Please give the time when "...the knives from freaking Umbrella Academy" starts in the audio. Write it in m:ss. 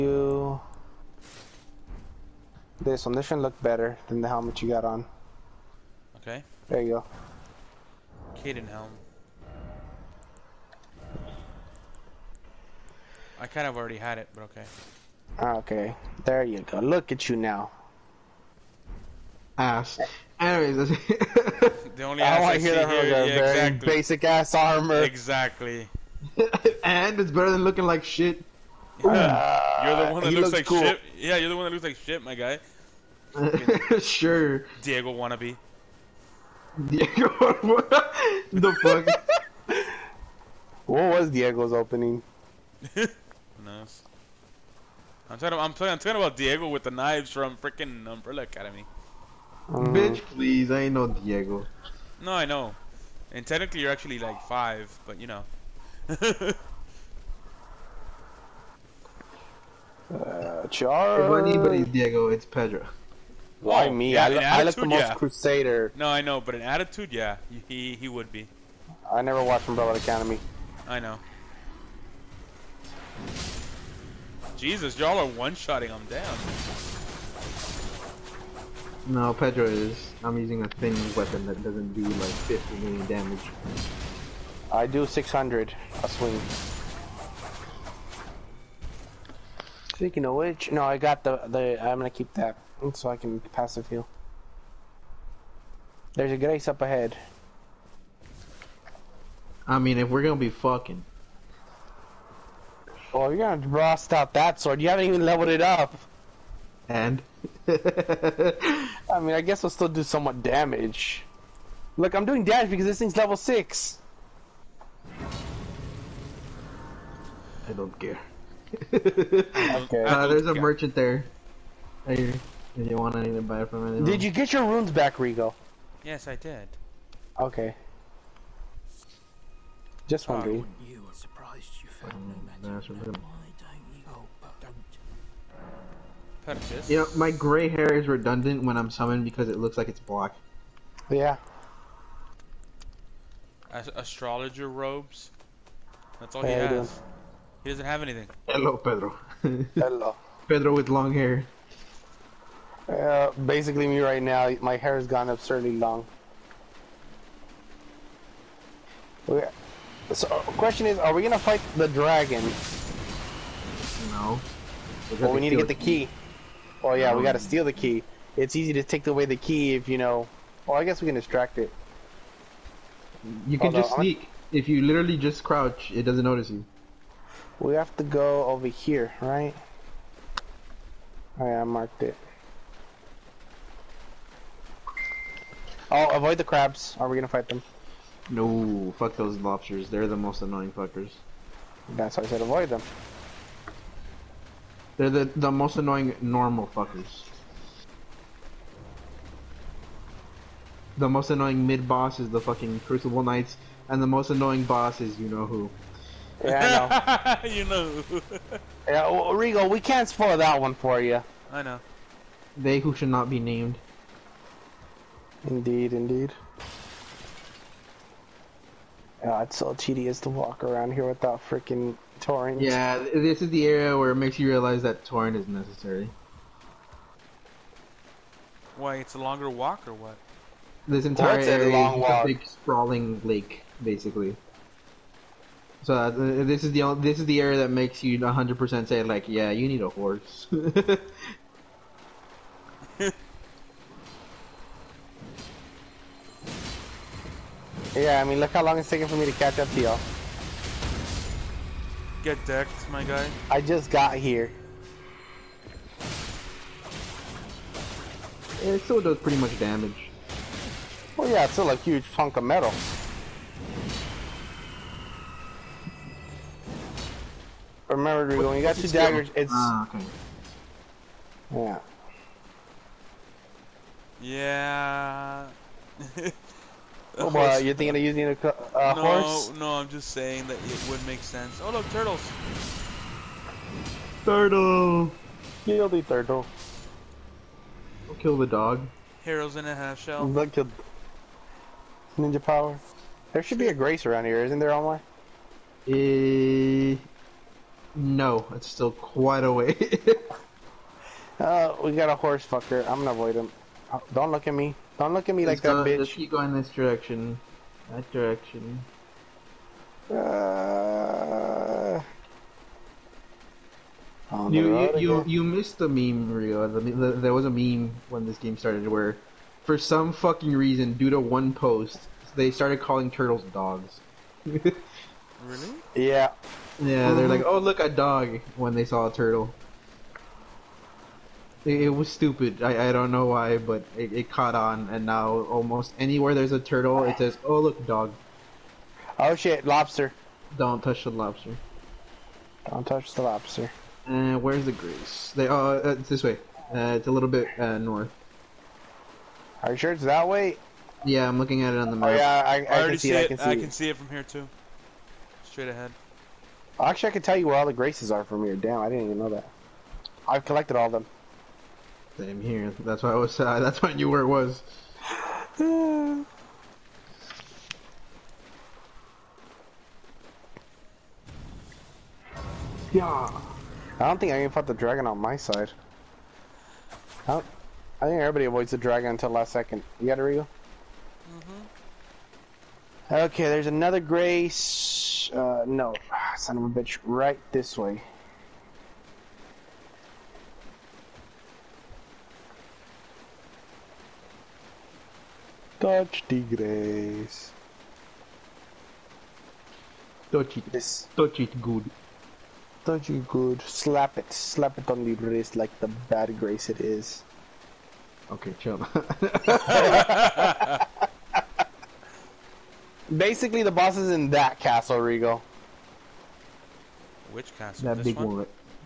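0:46.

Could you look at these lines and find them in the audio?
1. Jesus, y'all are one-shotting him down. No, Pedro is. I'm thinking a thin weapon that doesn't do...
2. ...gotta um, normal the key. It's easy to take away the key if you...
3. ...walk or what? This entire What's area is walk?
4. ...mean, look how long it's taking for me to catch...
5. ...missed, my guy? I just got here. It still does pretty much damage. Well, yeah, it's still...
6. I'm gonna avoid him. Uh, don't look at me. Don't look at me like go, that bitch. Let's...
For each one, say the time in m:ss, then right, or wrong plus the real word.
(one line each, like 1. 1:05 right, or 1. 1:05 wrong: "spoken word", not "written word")
1. 1:14 wrong: "using", not "thinking"
2. 2:47 wrong: "steal", not "normal"
3. 3:49 right
4. 4:08 right
5. 4:12 wrong: "decked", not "missed"
6. 5:02 right.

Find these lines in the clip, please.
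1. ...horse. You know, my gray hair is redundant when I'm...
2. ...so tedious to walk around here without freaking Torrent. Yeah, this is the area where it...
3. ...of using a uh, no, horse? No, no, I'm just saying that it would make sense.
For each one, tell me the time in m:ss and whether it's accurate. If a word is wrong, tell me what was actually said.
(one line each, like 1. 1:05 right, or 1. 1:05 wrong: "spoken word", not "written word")
1. 2:16 wrong: "purchase", not "horse"
2. 3:39 right
3. 4:37 right.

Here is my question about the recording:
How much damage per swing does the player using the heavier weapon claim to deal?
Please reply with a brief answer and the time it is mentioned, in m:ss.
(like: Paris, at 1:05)
600, at 1:25.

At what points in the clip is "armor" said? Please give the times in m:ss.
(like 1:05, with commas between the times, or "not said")
0:24.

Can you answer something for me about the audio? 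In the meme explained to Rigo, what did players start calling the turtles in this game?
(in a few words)
Dogs.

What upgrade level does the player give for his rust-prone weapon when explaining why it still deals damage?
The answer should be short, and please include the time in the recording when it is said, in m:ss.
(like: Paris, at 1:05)
6, at 1:53.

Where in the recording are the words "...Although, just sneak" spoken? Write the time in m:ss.
2:53.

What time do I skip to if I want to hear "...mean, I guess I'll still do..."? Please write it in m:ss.
1:49.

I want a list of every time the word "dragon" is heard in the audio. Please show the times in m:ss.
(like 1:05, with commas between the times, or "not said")
2:41, 6:14, 6:18.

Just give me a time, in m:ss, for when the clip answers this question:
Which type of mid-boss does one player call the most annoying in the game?
3:22.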